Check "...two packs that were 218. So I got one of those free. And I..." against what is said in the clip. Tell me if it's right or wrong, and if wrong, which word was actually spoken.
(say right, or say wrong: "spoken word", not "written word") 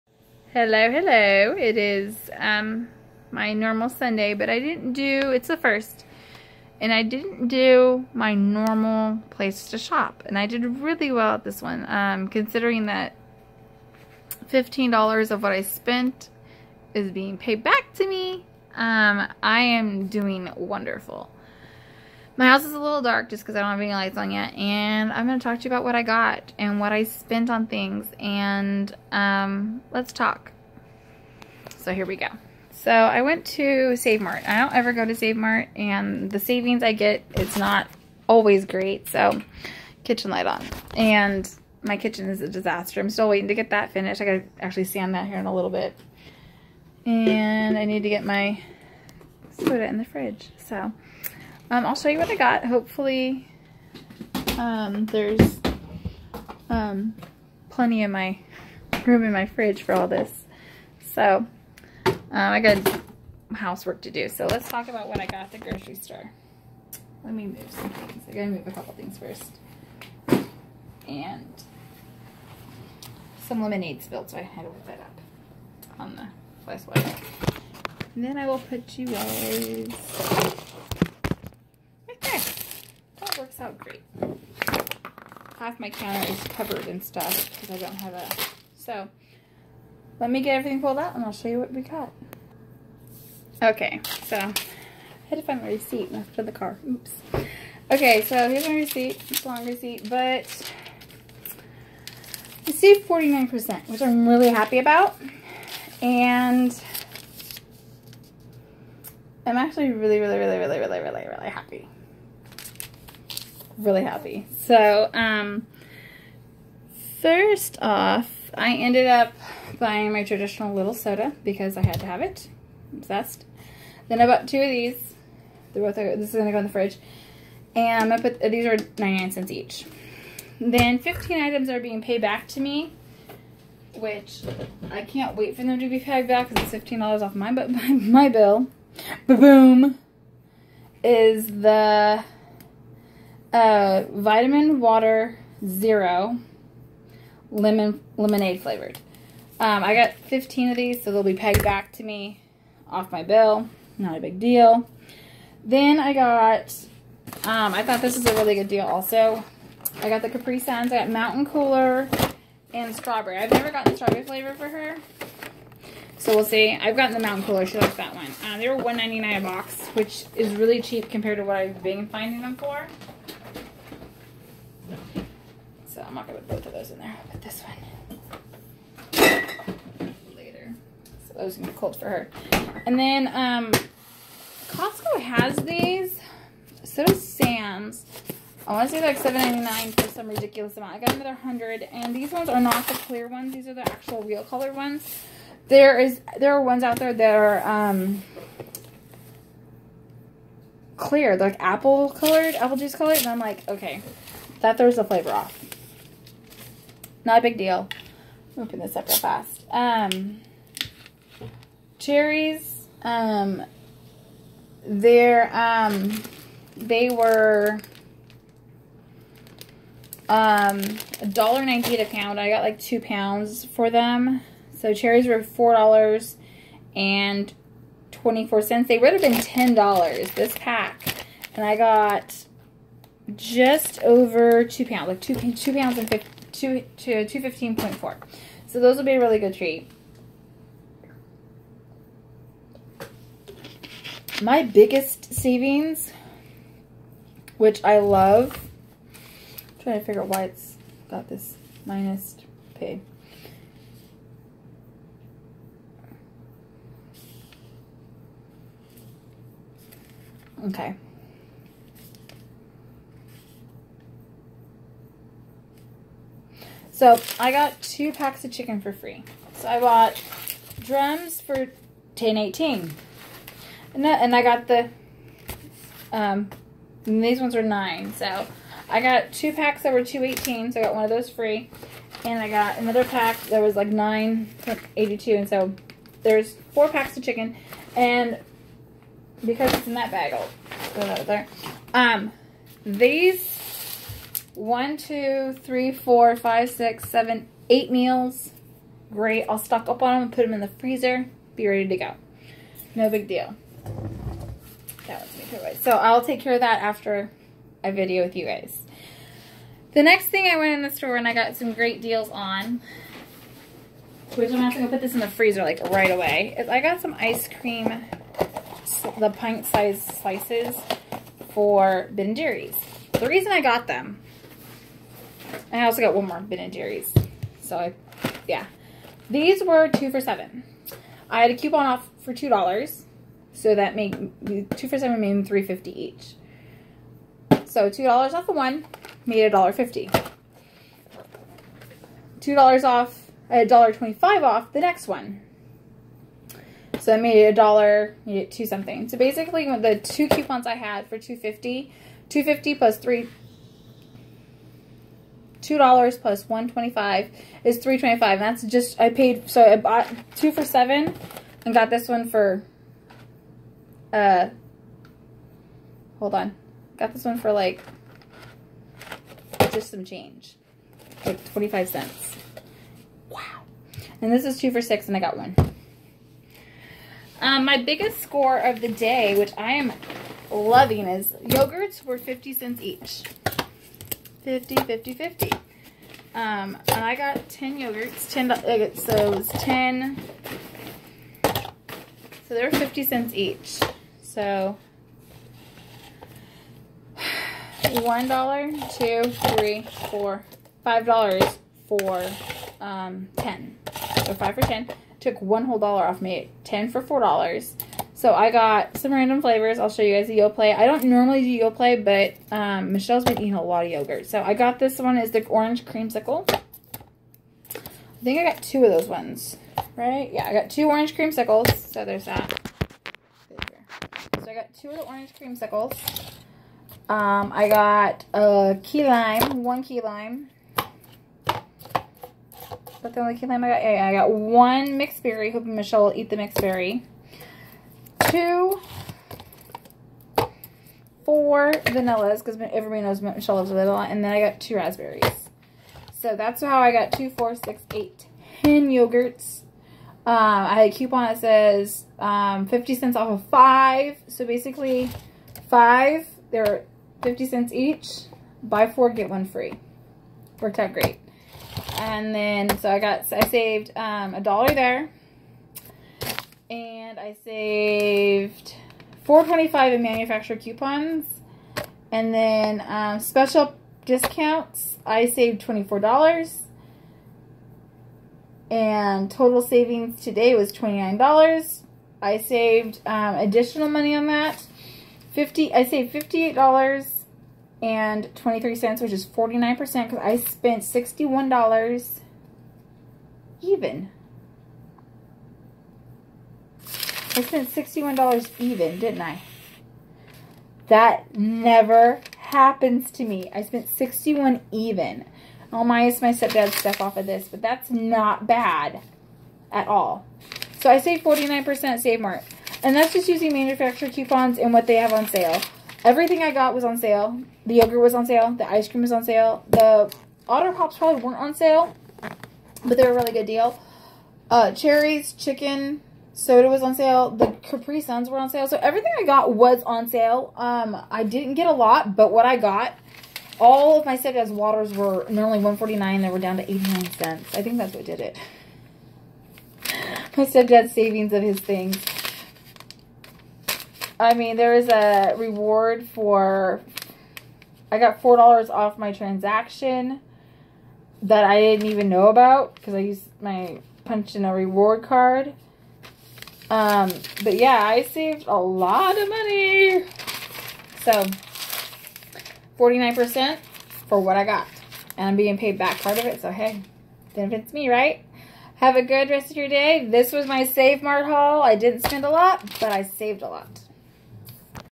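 right.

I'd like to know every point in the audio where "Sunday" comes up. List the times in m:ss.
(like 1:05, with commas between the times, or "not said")
0:03.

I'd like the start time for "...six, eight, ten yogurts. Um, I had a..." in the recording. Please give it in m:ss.
7:27.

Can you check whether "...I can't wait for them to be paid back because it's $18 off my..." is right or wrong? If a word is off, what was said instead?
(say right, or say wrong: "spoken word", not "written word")
wrong: "15", not "18".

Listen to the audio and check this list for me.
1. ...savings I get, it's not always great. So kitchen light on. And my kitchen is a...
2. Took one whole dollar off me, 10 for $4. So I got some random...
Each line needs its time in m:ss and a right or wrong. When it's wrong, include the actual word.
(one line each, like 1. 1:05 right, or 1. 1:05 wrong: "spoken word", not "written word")
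1. 0:36 right
2. 6:45 right.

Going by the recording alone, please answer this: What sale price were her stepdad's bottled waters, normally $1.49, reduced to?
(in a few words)
89 cents.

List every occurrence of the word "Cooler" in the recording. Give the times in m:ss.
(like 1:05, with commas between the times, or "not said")
2:41, 2:47.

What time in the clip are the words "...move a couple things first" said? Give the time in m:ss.
1:08.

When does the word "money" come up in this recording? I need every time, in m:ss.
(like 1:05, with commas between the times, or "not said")
8:03, 9:19.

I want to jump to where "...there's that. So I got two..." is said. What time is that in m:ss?
7:02.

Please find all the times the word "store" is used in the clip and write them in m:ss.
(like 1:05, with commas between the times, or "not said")
1:05, 5:10.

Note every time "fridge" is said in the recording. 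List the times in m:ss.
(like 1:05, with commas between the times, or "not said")
0:50, 0:59, 2:06.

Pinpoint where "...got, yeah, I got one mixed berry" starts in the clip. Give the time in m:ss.
7:13.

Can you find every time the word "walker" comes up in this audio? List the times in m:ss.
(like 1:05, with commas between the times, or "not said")
not said.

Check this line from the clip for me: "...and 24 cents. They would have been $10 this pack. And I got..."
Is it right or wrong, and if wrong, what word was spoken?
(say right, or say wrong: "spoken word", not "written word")
right.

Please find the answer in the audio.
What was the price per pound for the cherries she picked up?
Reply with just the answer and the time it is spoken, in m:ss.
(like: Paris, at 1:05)
$1.98, at 3:41.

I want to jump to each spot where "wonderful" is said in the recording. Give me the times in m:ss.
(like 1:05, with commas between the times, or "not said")
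0:20.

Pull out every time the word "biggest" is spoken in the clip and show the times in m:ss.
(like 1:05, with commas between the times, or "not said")
4:04, 6:17.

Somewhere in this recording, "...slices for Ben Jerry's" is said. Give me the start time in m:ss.
5:20.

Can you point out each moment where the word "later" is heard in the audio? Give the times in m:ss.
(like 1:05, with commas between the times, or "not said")
3:00.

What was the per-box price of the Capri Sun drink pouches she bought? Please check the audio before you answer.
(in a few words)
$1.99.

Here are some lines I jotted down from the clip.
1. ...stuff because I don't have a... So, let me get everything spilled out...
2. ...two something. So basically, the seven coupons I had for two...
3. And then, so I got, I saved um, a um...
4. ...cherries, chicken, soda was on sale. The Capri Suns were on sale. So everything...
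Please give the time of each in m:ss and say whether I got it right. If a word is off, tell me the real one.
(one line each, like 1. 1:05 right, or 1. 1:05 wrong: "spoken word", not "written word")
1. 1:27 wrong: "pulled", not "spilled"
2. 5:48 wrong: "two", not "seven"
3. 7:41 right
4. 8:44 right.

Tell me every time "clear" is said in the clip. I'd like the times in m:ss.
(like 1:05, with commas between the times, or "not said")
3:12, 3:20.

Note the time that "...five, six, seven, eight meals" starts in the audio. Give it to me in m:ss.
4:56.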